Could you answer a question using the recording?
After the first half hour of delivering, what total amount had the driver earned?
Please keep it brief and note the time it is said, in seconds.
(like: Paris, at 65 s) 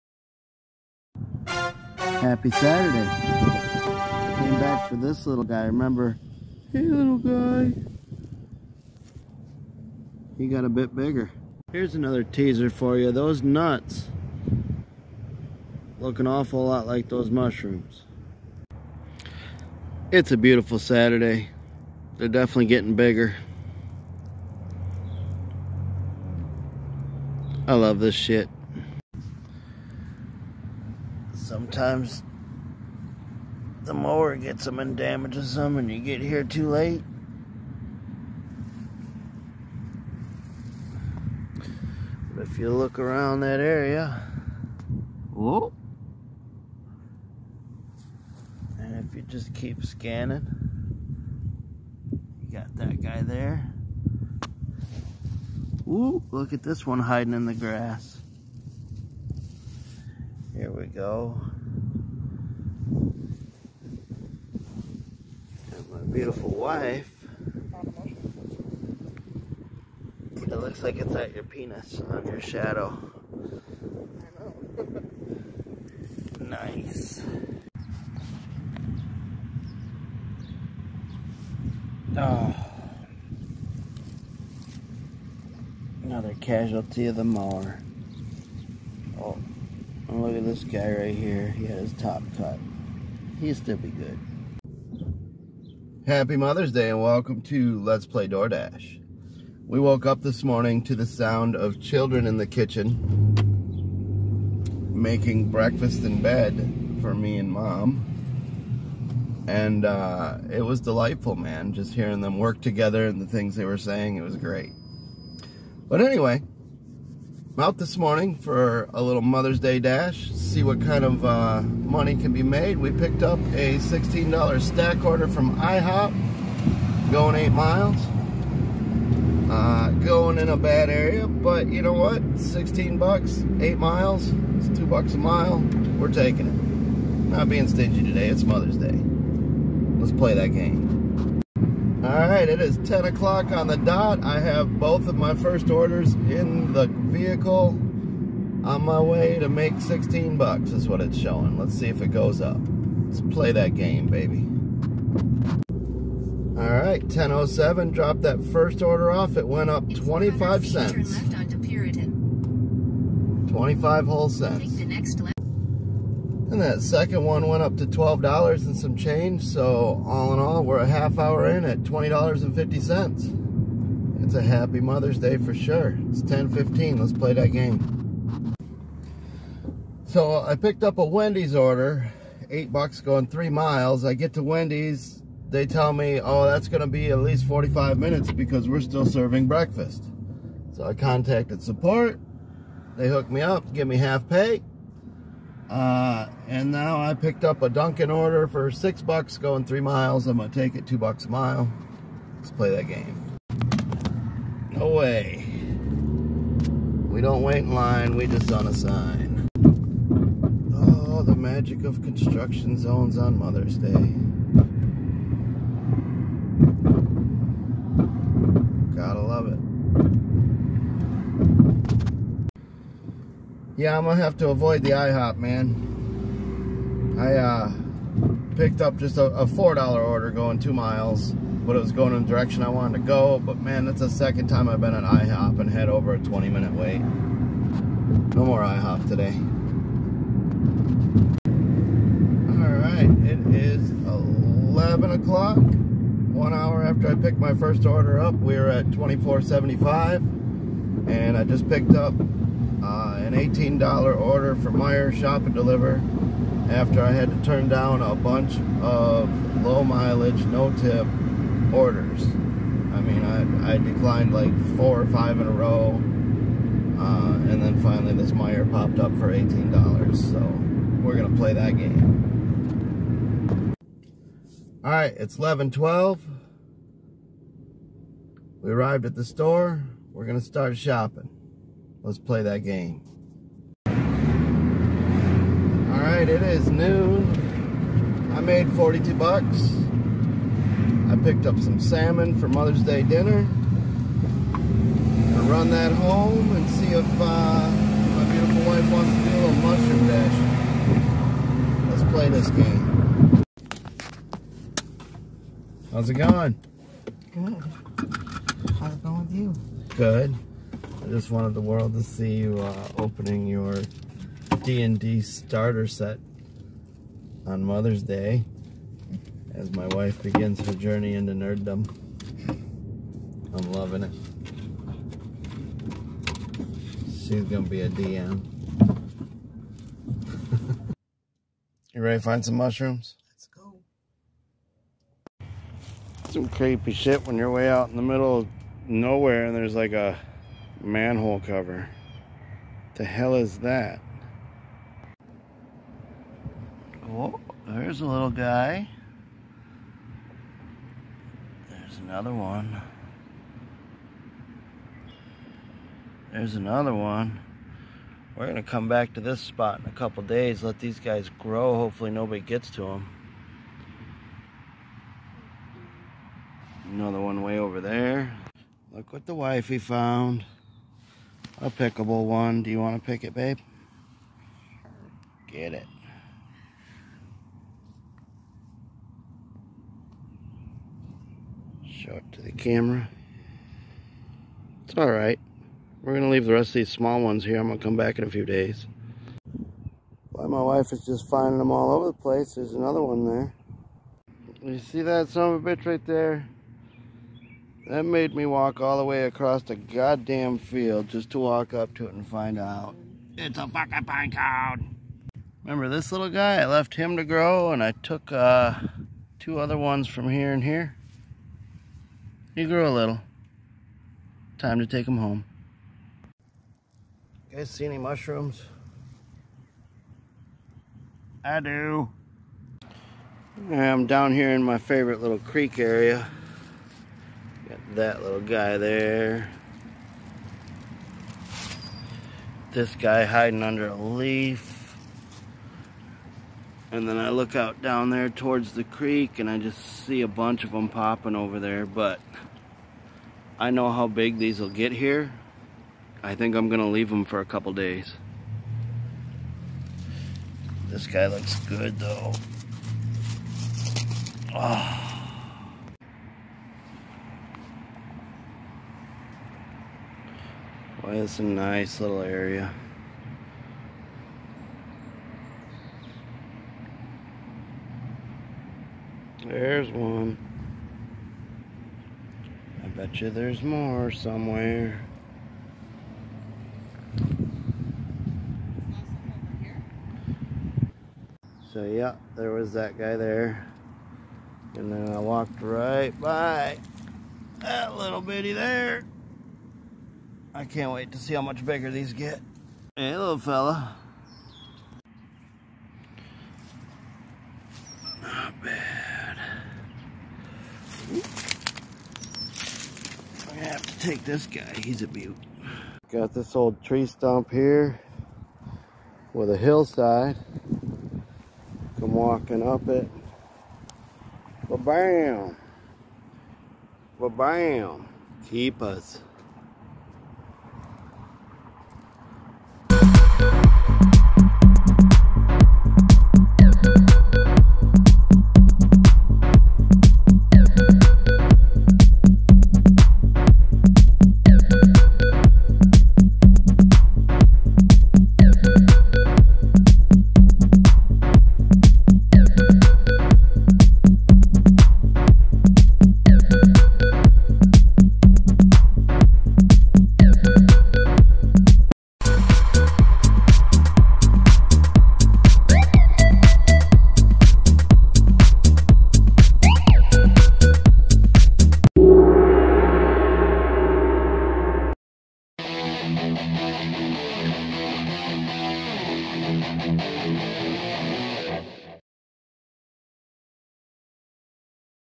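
$20.50, at 171 s.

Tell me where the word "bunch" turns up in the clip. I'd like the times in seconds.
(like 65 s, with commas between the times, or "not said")
258 s, 440 s.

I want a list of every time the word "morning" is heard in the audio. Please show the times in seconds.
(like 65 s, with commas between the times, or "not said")
100 s, 117 s.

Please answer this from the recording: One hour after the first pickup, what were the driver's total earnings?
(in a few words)
$24.75.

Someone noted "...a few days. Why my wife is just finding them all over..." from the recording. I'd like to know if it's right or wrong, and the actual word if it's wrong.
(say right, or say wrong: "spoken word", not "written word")
right.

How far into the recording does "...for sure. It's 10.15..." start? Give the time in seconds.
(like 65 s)
175 s.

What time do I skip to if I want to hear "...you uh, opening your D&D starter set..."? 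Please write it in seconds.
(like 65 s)
312 s.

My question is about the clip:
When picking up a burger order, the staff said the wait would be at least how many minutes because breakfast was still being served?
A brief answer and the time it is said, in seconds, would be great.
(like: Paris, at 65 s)
45, at 187 s.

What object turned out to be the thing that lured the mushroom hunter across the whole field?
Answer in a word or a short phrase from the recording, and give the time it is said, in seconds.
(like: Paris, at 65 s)
pine cone, at 404 s.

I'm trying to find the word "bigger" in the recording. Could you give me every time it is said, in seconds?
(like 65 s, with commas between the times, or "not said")
10 s, 22 s, 491 s.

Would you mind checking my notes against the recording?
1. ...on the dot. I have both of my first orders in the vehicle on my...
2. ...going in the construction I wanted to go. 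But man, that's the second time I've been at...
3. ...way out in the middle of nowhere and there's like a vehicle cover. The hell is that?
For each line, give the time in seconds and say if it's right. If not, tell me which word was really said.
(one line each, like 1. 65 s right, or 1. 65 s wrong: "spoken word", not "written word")
1. 143 s right
2. 231 s wrong: "direction", not "construction"
3. 337 s wrong: "manhole", not "vehicle".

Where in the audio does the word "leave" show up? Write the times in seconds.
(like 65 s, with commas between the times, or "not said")
386 s, 446 s.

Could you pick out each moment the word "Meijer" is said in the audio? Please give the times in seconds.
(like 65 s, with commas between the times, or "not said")
254 s, 268 s.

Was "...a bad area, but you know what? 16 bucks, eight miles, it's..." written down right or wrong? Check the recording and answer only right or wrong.
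right.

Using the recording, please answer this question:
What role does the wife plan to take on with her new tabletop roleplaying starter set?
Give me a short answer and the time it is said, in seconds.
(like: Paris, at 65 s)
DM, at 327 s.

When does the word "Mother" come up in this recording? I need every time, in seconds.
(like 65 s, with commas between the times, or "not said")
96 s, 119 s, 138 s, 174 s, 213 s, 292 s, 317 s.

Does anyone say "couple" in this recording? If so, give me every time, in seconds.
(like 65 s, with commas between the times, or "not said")
359 s, 447 s.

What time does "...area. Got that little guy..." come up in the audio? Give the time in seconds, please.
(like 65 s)
425 s.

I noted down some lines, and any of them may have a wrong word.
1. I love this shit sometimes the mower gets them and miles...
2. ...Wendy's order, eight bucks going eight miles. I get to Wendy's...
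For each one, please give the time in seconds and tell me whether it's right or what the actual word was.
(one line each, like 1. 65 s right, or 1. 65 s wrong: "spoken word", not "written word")
1. 27 s wrong: "damages", not "miles"
2. 181 s wrong: "three", not "eight".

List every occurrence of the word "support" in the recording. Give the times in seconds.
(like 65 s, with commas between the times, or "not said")
191 s.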